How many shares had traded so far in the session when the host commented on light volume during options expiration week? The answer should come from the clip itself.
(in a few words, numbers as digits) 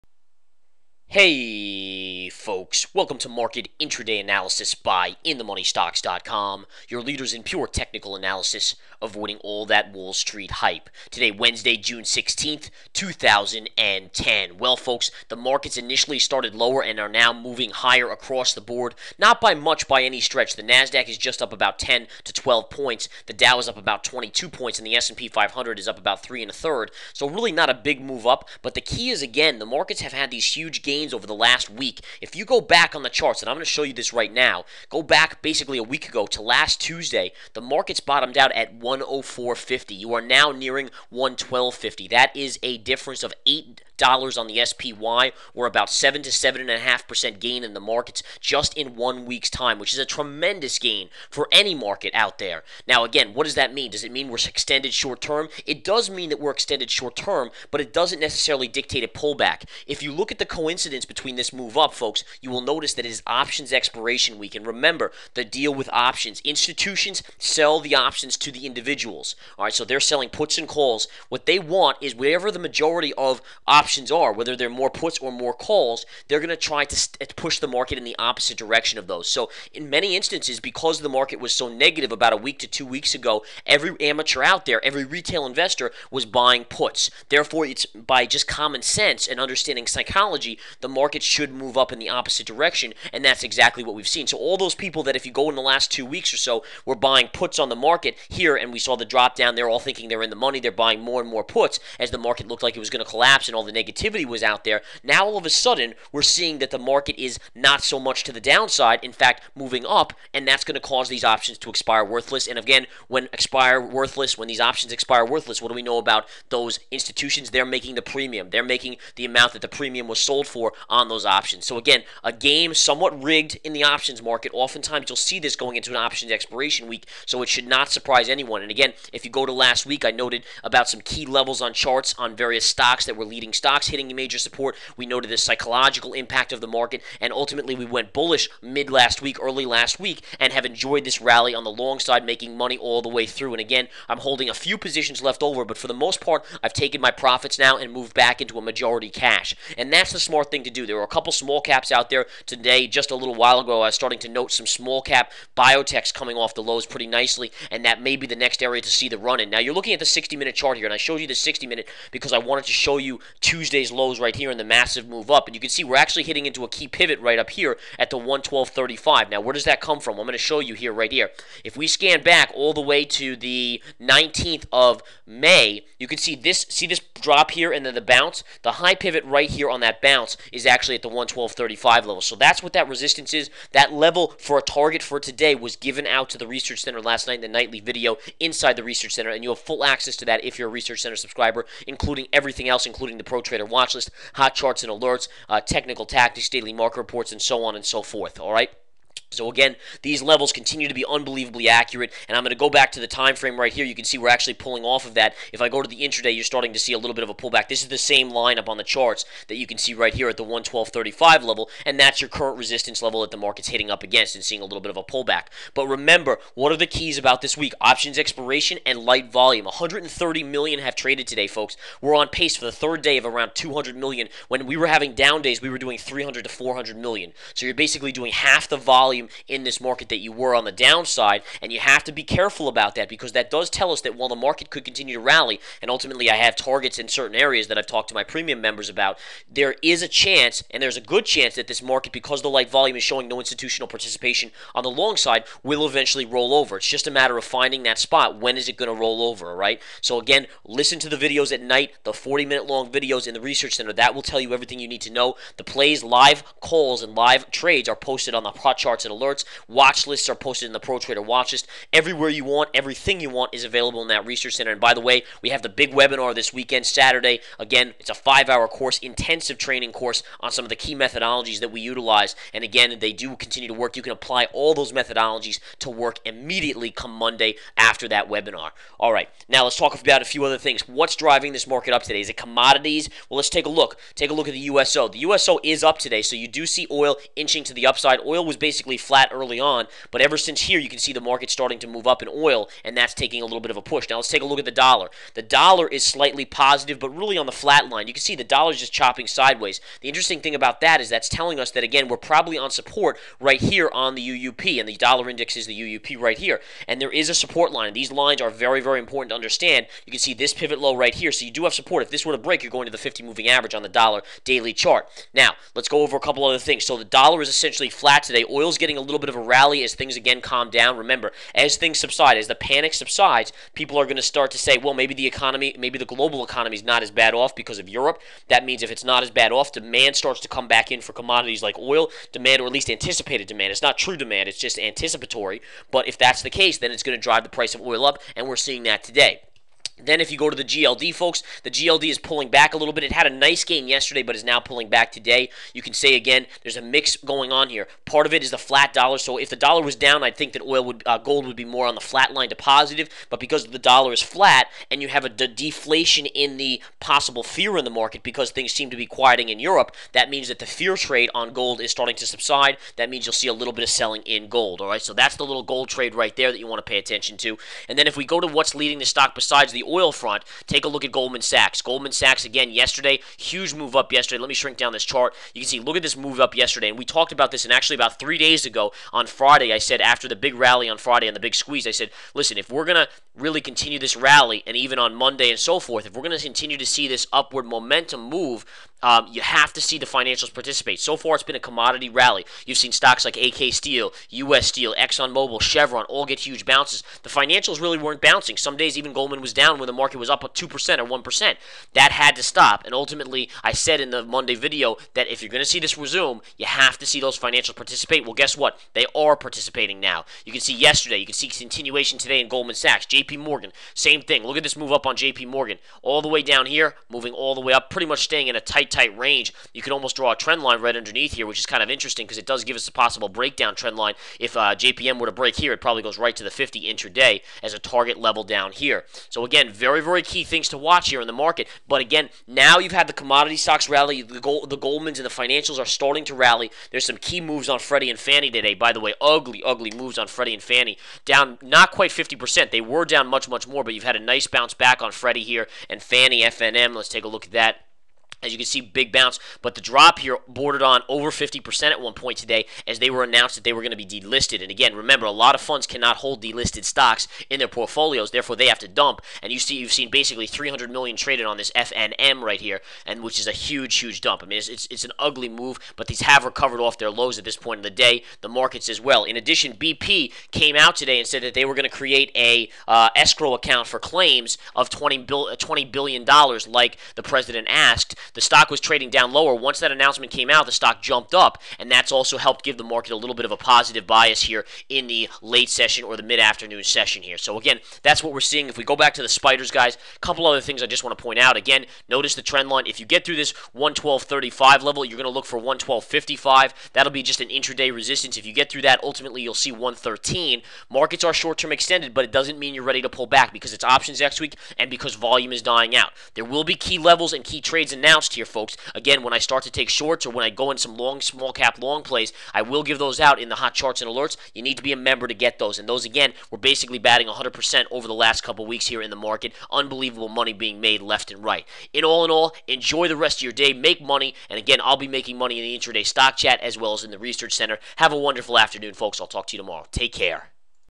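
130 million.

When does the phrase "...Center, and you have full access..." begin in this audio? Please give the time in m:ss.
3:09.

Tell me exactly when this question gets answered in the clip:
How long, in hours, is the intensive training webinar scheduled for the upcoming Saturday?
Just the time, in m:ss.
4:28.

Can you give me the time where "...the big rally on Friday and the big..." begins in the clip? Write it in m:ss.
6:20.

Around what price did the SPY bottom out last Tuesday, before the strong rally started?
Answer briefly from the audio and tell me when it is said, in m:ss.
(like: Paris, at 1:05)
104.50, at 0:38.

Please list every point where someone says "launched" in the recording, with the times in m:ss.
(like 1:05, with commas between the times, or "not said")
not said.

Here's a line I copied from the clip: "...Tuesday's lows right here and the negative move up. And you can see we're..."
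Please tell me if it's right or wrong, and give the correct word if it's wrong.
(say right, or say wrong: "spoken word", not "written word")
wrong: "massive", not "negative".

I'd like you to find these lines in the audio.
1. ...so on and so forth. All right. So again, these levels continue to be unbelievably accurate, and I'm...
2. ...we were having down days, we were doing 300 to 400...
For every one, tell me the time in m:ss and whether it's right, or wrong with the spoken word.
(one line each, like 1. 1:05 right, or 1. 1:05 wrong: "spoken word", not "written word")
1. 3:17 right
2. 3:44 right.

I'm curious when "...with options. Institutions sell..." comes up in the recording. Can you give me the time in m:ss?
1:05.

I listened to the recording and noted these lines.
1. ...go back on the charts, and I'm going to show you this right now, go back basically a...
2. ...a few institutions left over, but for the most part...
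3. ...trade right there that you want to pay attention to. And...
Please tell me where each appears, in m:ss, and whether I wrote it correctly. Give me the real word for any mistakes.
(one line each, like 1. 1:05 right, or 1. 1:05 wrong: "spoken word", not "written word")
1. 0:32 right
2. 2:24 wrong: "positions", not "institutions"
3. 6:05 right.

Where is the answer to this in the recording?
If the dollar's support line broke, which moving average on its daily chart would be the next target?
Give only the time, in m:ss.
5:12.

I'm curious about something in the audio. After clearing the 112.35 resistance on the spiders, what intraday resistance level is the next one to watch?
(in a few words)
112.55.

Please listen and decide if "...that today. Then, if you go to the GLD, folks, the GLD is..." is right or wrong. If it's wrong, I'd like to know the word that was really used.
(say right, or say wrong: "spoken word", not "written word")
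right.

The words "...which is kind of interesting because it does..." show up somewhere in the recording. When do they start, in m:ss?
7:01.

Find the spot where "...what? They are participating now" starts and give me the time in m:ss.
6:48.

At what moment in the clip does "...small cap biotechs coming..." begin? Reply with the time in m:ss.
2:34.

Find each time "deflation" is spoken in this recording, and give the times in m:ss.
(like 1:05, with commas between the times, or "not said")
5:55.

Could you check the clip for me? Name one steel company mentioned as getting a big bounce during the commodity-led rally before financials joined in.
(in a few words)
AK Steel.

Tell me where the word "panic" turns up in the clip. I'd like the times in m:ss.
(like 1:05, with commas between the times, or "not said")
5:22.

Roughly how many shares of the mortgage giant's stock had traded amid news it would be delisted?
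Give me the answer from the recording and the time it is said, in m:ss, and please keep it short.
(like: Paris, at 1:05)
300 million, at 7:40.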